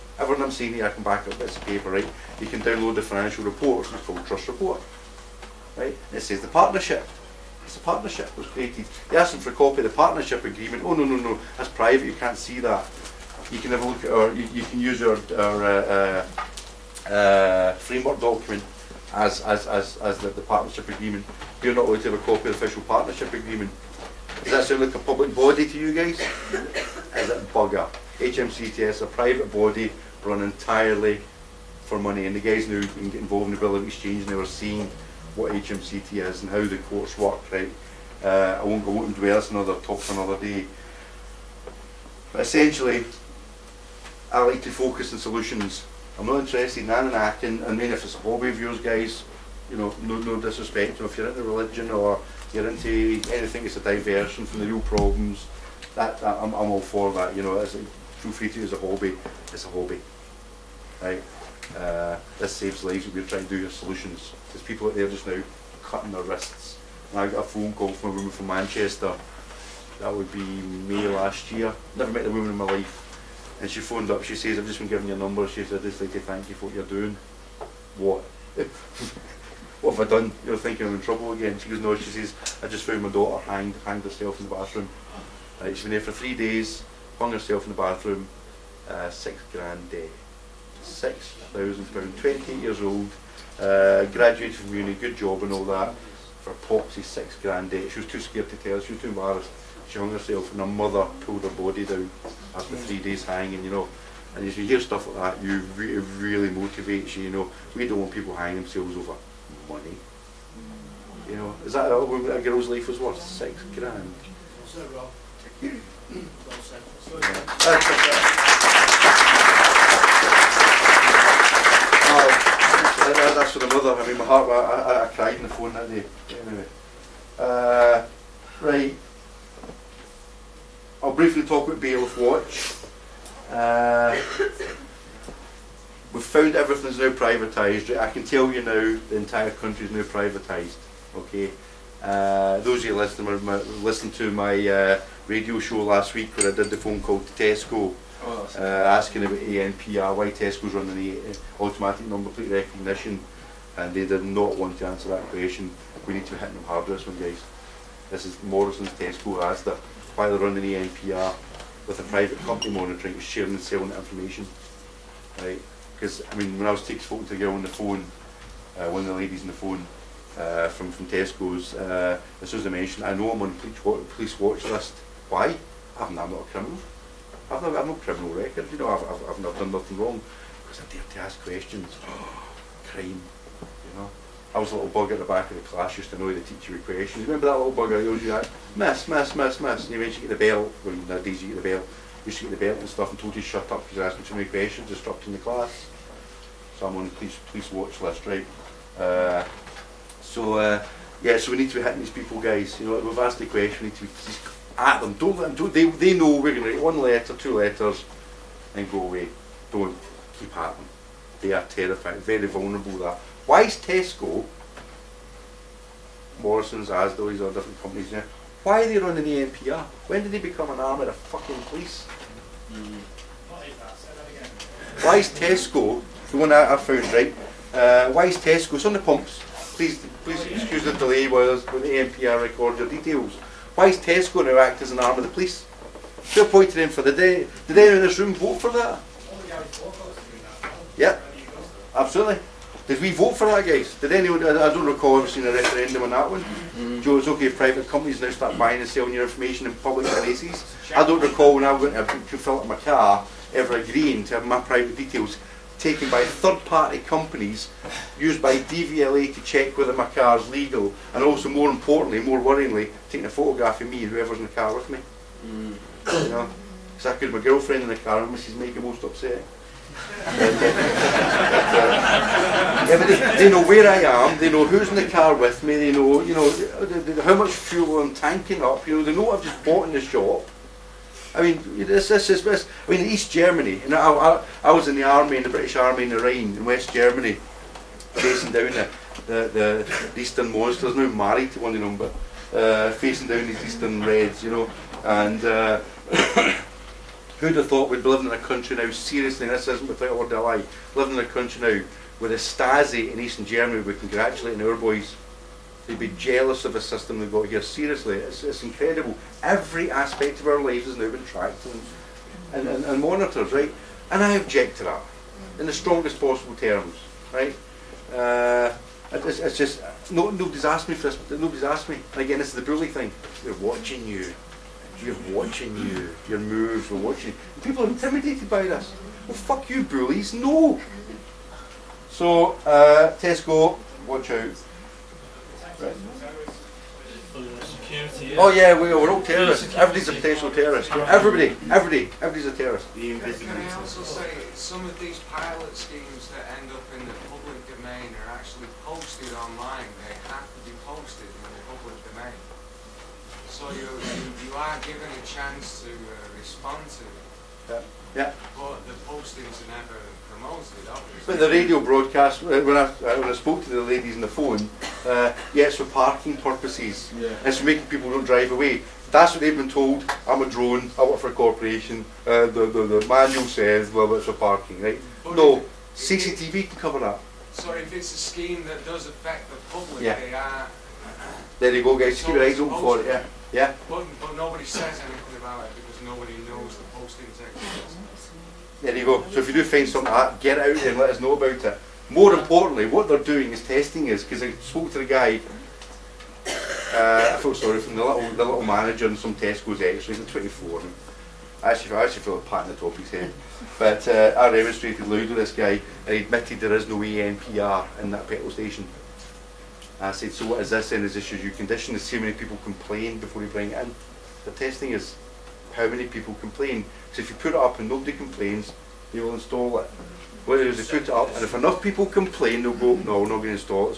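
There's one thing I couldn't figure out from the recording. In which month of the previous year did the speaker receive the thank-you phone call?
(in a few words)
May.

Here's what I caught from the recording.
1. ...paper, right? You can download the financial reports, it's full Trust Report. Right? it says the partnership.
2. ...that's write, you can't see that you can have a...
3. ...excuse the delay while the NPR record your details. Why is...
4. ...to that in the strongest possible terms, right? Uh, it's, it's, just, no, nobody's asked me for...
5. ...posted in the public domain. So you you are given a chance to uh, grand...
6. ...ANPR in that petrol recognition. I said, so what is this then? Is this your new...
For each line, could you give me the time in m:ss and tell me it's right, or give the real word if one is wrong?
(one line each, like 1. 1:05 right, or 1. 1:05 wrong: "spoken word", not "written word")
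1. 0:01 right
2. 0:11 wrong: "private", not "write"
3. 3:50 right
4. 5:14 right
5. 5:50 wrong: "respond", not "grand"
6. 6:46 wrong: "station", not "recognition".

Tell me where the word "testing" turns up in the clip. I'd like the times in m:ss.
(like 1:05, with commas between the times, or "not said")
6:33, 6:54.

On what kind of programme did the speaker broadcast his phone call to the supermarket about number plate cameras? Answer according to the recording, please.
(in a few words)
Radio show.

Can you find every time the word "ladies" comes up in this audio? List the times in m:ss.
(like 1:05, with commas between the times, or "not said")
2:49, 6:03.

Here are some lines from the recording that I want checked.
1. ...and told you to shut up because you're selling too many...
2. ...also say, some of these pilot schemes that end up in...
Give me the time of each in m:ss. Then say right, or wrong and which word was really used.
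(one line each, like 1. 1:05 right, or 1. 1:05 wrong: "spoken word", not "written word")
1. 3:13 wrong: "asking", not "selling"
2. 5:43 right.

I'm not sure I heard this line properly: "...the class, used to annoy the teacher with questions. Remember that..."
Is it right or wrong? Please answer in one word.
right.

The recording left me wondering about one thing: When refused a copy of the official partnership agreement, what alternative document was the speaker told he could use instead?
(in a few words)
Framework document.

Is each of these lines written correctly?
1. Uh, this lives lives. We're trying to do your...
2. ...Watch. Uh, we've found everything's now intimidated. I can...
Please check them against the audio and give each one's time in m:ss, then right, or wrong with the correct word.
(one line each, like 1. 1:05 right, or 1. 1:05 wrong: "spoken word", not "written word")
1. 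1:01 wrong: "saves", not "lives"
2. 2:12 wrong: "privatised", not "intimidated".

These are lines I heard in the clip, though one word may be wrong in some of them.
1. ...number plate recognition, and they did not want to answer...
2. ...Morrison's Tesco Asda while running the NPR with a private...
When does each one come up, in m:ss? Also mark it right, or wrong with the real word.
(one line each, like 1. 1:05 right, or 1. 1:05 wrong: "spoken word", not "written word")
1. 2:32 right
2. 2:38 right.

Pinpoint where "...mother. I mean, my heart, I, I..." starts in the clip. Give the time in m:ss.
2:03.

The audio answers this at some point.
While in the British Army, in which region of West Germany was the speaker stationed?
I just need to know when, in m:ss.
4:46.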